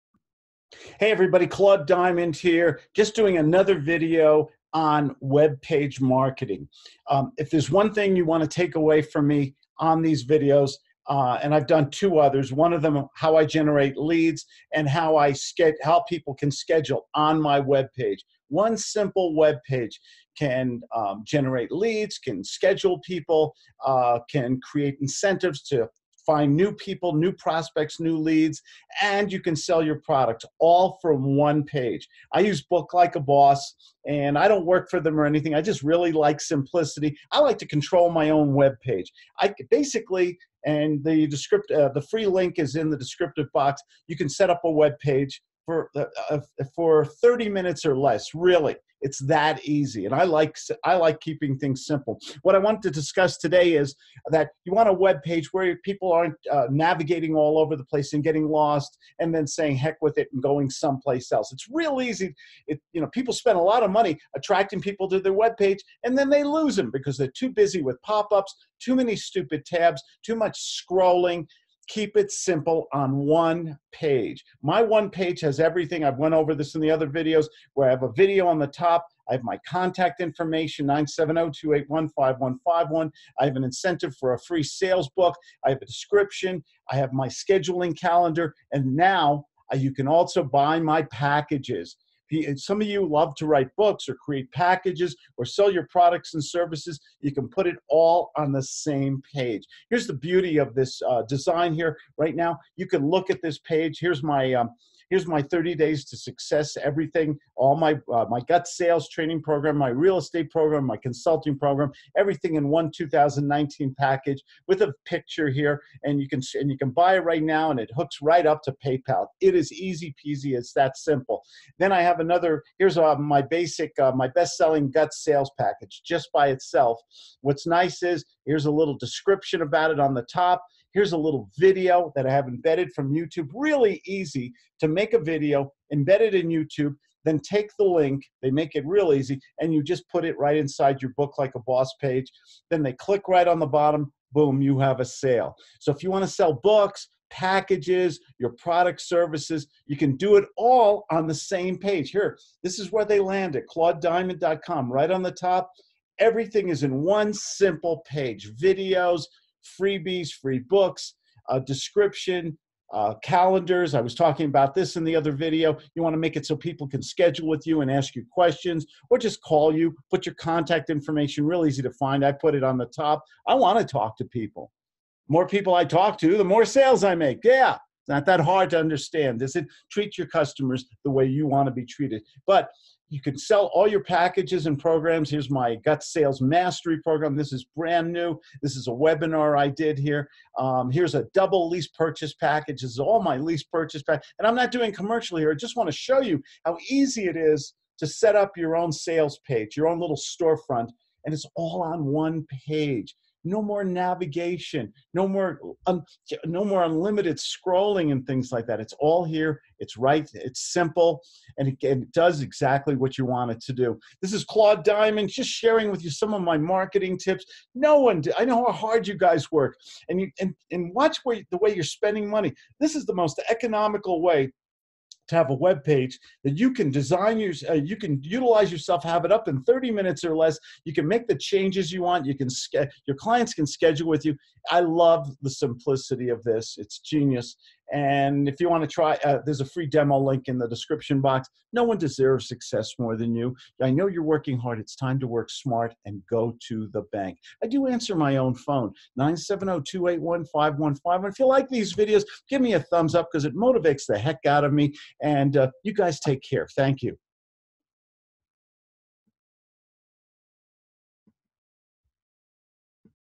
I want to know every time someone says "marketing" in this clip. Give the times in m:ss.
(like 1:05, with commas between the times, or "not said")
0:05, 3:36.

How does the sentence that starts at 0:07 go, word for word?
Um, if there's one thing you want to take away from me on these videos, uh, and I've done two others.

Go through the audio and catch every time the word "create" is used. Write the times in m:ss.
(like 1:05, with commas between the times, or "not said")
0:24, 1:34.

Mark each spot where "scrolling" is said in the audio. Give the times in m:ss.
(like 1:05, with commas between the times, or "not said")
1:10, 3:27.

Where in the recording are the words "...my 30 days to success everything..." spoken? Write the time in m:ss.
1:45.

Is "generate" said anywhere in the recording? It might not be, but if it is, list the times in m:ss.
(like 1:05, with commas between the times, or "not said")
0:13, 0:21.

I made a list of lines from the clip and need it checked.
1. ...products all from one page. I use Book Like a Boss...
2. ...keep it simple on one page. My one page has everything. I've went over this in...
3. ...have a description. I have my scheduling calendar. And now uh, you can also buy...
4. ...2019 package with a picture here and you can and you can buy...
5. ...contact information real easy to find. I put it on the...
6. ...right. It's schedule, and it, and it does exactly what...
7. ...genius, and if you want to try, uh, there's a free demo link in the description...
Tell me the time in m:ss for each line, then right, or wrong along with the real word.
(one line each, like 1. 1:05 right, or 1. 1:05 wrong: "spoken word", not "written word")
1. 0:30 right
2. 1:11 right
3. 1:25 right
4. 1:52 right
5. 2:50 right
6. 3:29 wrong: "simple", not "schedule"
7. 3:56 right.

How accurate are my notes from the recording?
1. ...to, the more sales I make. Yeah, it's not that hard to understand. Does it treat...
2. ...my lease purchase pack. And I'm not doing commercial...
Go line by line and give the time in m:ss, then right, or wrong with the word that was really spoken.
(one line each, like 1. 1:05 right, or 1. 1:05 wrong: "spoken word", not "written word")
1. 2:56 right
2. 3:13 right.